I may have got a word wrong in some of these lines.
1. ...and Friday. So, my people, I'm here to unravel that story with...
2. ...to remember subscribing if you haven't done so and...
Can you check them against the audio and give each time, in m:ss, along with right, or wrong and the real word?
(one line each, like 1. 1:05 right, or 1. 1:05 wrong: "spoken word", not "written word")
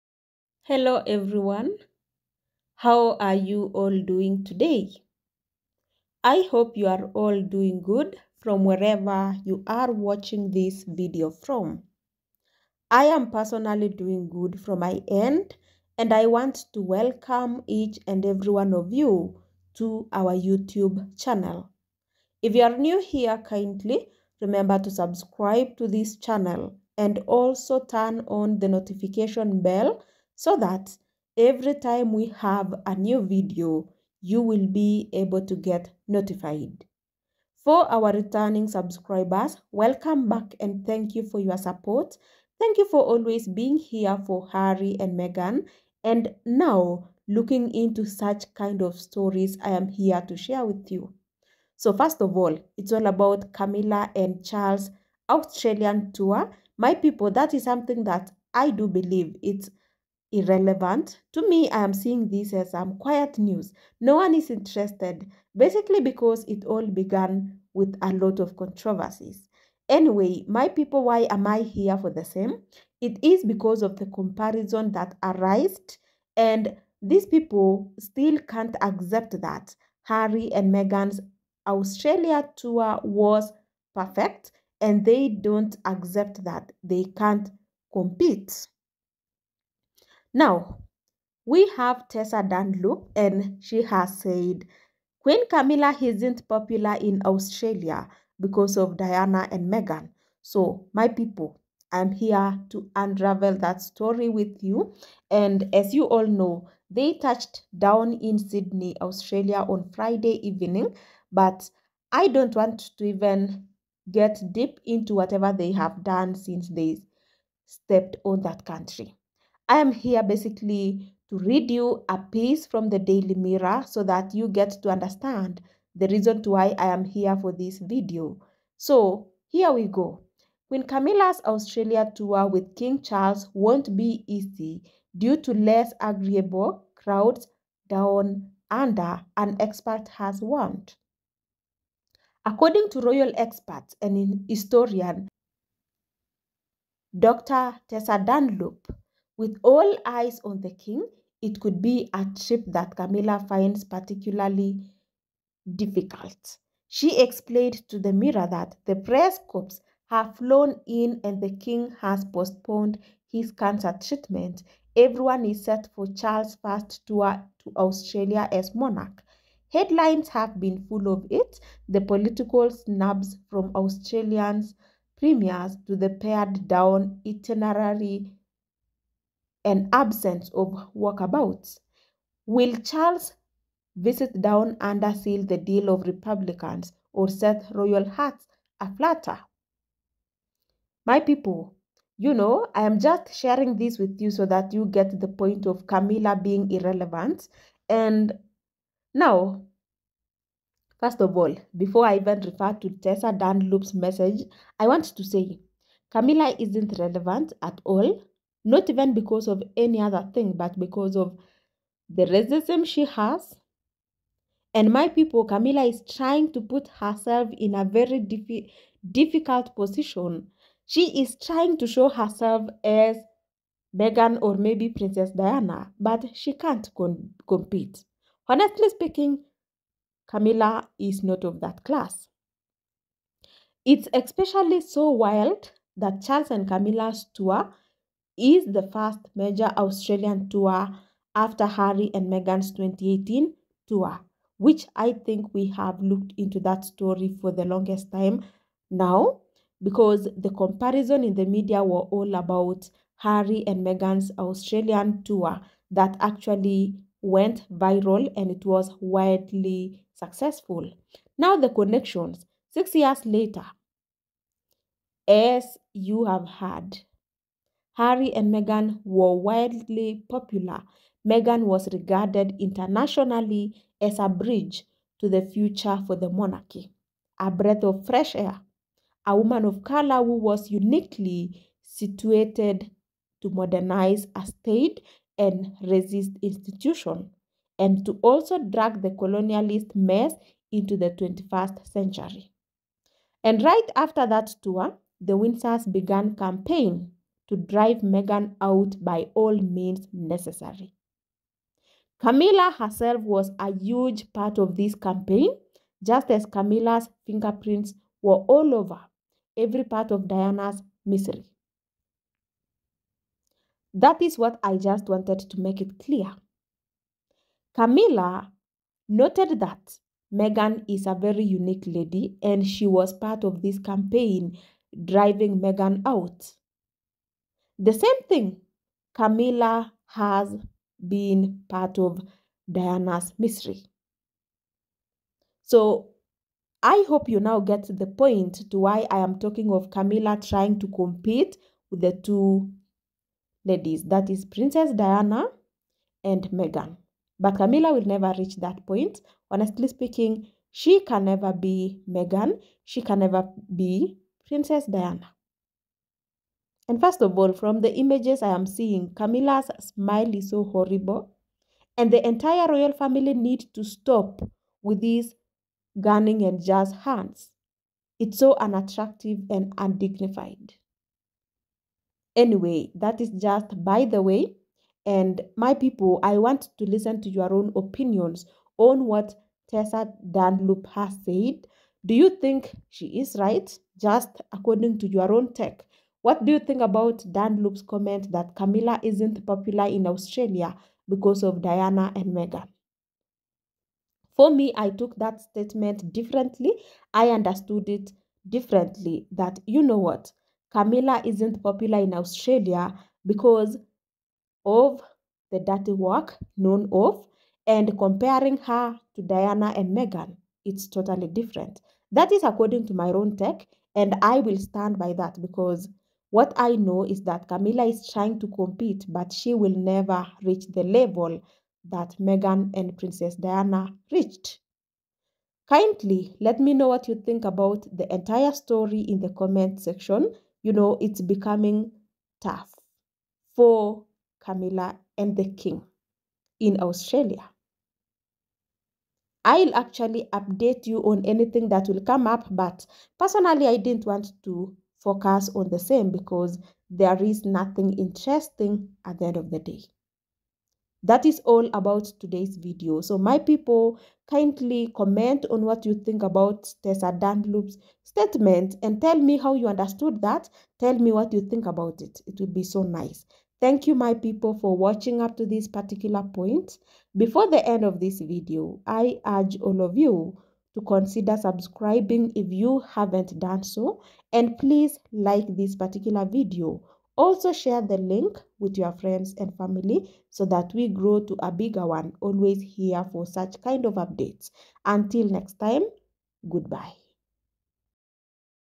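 1. 1:39 wrong: "Meghan", not "Friday"
2. 7:50 wrong: "consider", not "remember".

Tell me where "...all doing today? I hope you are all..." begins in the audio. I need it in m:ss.
0:03.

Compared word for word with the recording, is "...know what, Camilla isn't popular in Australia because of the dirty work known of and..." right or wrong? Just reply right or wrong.
right.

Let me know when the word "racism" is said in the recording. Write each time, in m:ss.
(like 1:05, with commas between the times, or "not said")
3:32.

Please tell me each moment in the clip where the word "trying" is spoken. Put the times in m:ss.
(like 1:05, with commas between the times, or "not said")
3:36, 3:41, 5:40, 6:58.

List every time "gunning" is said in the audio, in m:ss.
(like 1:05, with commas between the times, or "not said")
6:06.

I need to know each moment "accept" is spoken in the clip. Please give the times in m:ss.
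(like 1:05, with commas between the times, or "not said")
1:18, 1:25.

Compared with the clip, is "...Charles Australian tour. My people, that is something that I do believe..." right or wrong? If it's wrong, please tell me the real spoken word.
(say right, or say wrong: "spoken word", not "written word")
right.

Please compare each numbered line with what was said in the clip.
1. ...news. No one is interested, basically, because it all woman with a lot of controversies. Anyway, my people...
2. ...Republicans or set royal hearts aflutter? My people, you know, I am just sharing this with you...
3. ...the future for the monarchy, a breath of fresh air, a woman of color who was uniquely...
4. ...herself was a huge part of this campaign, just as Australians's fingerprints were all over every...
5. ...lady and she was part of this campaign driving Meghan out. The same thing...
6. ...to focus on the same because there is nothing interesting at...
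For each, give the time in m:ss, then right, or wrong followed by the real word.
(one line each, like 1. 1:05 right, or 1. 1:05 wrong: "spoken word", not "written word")
1. 1:03 wrong: "began", not "woman"
2. 3:06 right
3. 4:35 right
4. 5:02 wrong: "Camilla", not "Australians"
5. 5:21 right
6. 7:24 right.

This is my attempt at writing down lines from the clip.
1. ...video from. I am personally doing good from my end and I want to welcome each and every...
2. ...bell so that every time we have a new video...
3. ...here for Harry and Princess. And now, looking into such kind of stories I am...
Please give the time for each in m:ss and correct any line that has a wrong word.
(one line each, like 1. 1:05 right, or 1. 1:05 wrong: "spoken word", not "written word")
1. 0:10 right
2. 0:29 right
3. 0:43 wrong: "Meghan", not "Princess".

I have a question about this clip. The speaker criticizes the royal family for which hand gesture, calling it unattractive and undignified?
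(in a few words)
jazz hands.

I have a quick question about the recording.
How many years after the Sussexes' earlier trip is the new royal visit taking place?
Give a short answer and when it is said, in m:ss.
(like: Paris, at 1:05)
6, at 4:22.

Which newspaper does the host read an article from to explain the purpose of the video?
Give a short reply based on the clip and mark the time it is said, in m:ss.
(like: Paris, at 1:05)
Daily Mirror, at 2:02.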